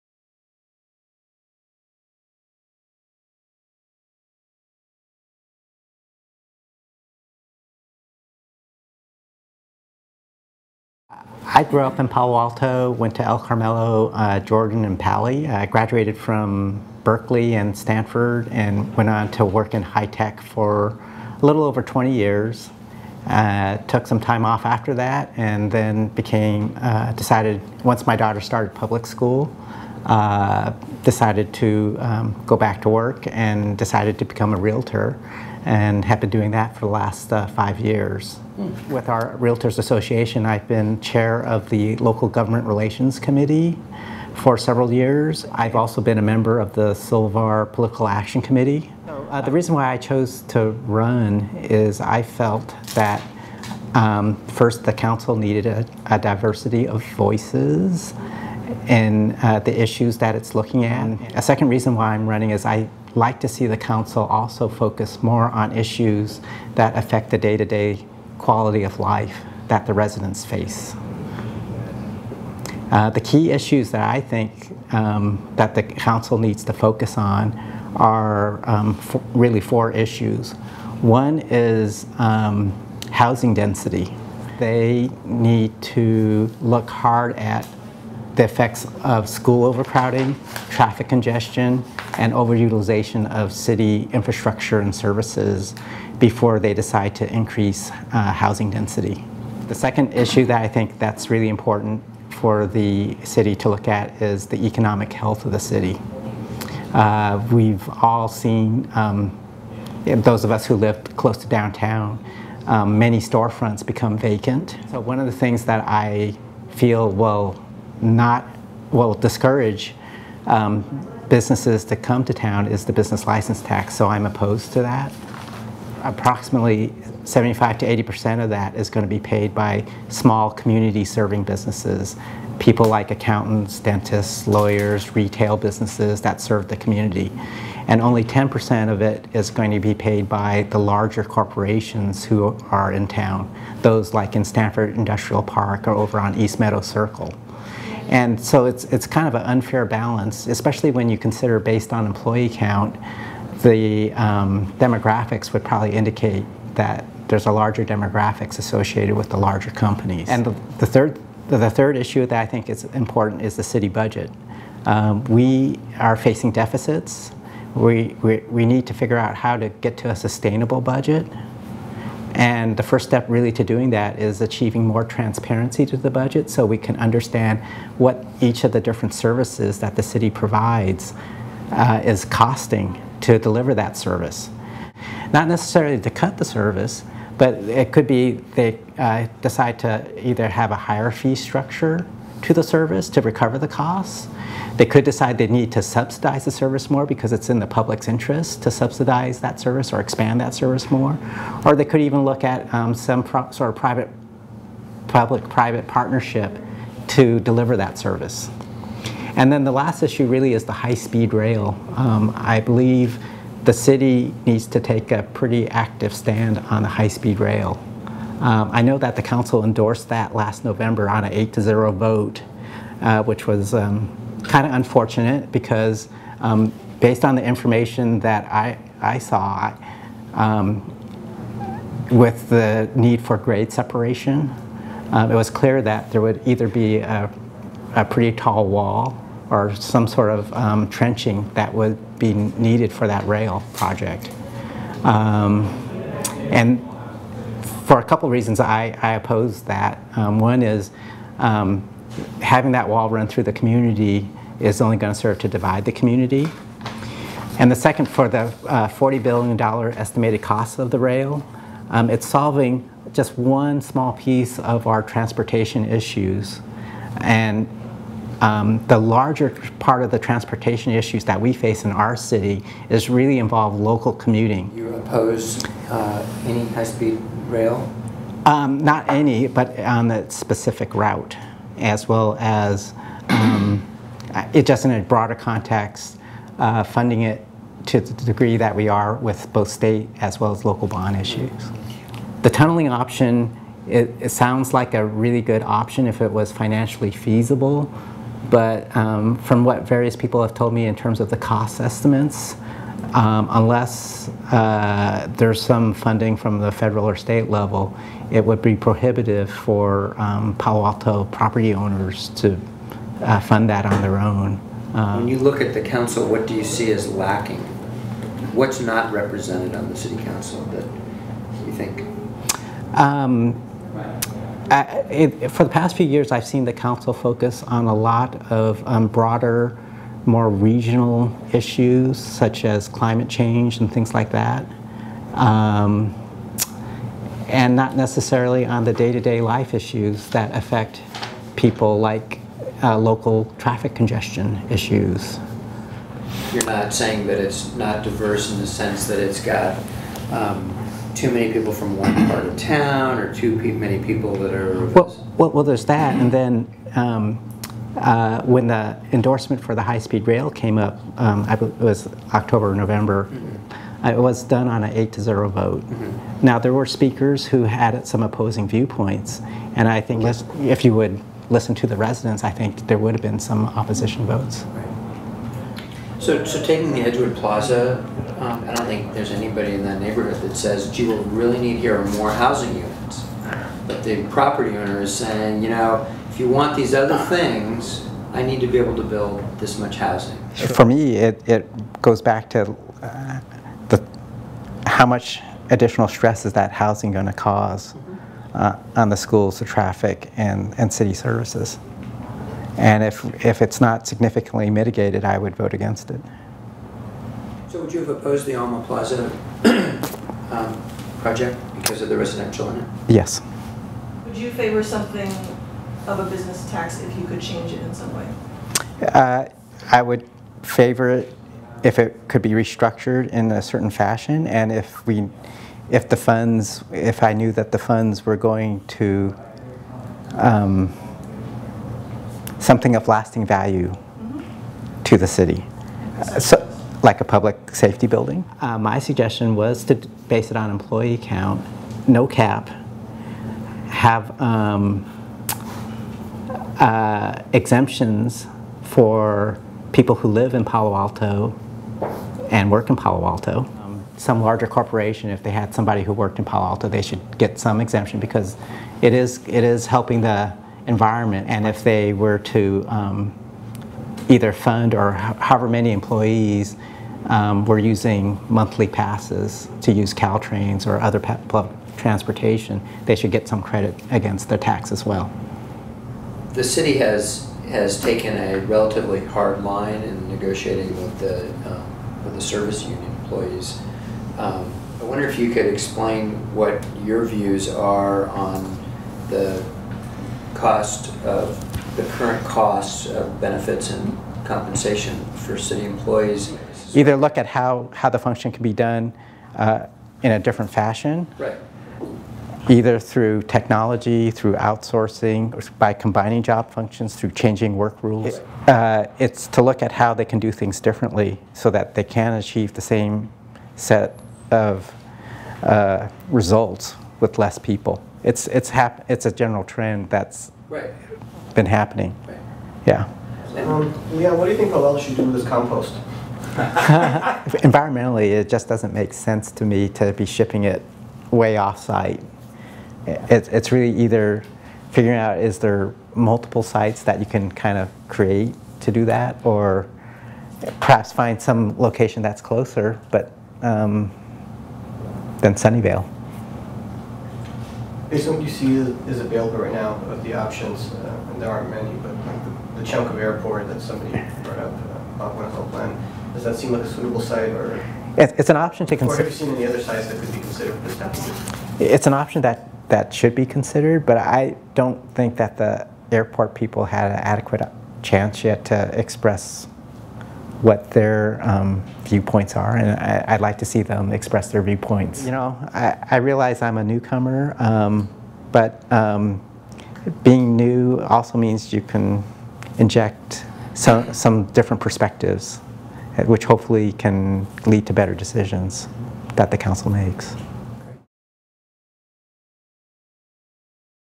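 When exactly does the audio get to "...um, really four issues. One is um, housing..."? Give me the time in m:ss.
1:18.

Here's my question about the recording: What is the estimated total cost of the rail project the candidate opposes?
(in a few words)
$40 billion.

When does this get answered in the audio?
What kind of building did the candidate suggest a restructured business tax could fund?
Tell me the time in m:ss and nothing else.
7:17.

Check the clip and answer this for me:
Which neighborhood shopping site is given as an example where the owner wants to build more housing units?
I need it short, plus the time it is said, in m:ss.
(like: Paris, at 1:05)
Edgewood Plaza, at 6:17.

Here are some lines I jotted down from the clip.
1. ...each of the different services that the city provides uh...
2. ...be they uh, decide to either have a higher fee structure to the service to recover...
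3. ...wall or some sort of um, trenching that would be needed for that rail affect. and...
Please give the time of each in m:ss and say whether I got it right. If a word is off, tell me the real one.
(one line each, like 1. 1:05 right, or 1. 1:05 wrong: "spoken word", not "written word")
1. 2:58 right
2. 3:08 right
3. 3:58 wrong: "project", not "affect".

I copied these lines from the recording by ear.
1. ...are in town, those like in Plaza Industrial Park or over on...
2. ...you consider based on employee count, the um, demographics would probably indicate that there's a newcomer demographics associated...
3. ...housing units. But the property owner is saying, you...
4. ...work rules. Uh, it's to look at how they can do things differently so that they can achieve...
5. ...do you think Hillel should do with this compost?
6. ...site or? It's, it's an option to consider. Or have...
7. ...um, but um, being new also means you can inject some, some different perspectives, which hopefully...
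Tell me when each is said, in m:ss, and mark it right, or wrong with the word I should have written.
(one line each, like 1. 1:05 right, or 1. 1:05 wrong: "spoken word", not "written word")
1. 2:22 wrong: "Stanford", not "Plaza"
2. 2:31 wrong: "larger", not "newcomer"
3. 6:22 right
4. 8:27 right
5. 8:44 right
6. 9:17 right
7. 9:37 right.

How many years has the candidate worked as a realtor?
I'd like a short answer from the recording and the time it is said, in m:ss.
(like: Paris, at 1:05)
5, at 0:37.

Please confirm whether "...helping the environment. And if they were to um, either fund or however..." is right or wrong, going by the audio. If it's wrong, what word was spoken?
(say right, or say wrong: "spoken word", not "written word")
right.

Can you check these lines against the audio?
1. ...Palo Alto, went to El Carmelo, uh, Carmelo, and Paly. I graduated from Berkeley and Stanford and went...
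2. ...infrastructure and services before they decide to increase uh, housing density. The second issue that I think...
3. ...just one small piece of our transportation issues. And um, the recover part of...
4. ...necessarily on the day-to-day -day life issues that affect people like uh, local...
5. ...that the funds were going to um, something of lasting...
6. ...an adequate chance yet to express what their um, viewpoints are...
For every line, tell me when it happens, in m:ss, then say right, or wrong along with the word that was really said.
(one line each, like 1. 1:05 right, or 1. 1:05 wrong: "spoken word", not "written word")
1. 0:12 wrong: "Jordan", not "Carmelo"
2. 1:34 right
3. 4:23 wrong: "larger", not "recover"
4. 5:37 right
5. 7:07 right
6. 9:27 right.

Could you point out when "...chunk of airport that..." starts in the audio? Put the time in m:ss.
9:12.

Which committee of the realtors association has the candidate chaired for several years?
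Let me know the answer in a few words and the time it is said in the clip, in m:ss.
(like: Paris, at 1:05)
Local Government Relations Committee, at 0:41.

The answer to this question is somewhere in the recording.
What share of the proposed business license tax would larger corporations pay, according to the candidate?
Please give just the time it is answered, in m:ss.
2:18.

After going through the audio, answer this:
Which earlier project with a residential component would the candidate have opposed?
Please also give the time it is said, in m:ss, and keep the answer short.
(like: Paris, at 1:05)
Alma Plaza, at 6:48.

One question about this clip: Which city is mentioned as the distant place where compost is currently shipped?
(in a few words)
Sunnyvale.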